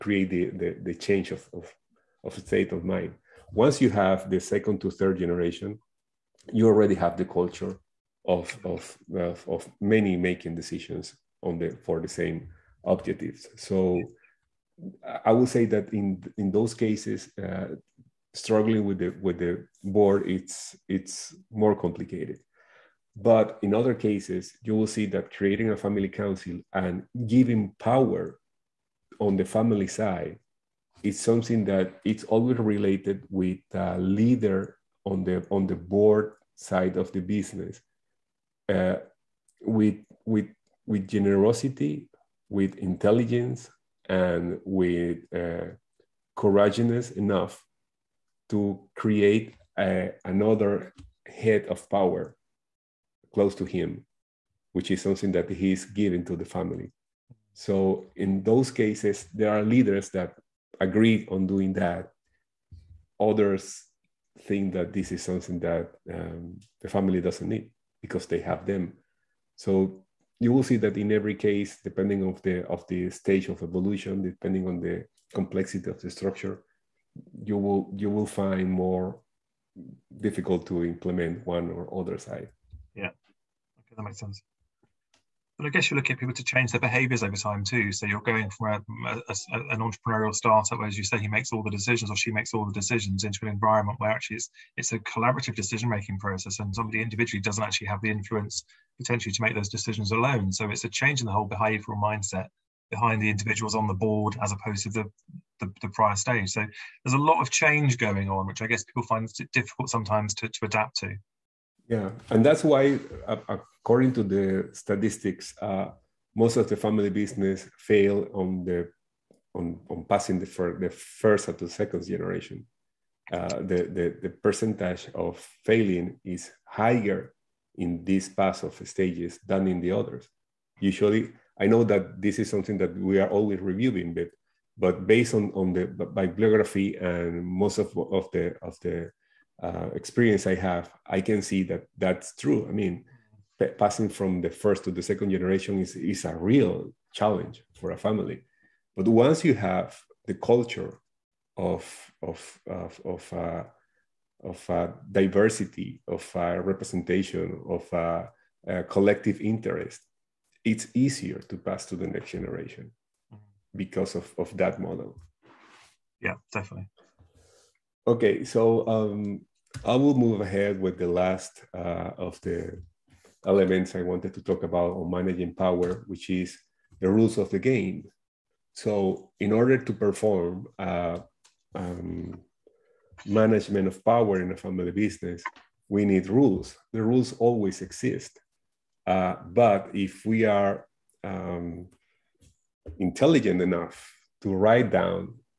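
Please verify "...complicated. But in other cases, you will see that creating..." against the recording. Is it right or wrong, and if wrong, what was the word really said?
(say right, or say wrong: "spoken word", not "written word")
right.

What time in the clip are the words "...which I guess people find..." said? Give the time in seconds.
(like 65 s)
108 s.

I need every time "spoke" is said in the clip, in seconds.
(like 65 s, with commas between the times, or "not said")
not said.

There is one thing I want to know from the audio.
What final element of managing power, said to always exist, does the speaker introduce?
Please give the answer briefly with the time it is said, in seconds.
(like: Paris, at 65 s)
The rules of the game, at 177 s.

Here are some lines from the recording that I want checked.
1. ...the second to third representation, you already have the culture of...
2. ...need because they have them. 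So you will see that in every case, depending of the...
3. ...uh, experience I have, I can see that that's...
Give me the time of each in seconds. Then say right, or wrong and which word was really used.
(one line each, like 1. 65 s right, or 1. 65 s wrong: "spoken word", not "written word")
1. 4 s wrong: "generation", not "representation"
2. 67 s right
3. 139 s right.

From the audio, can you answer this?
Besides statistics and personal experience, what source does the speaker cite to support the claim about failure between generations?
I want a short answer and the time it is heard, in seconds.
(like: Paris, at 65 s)
Bibliography, at 135 s.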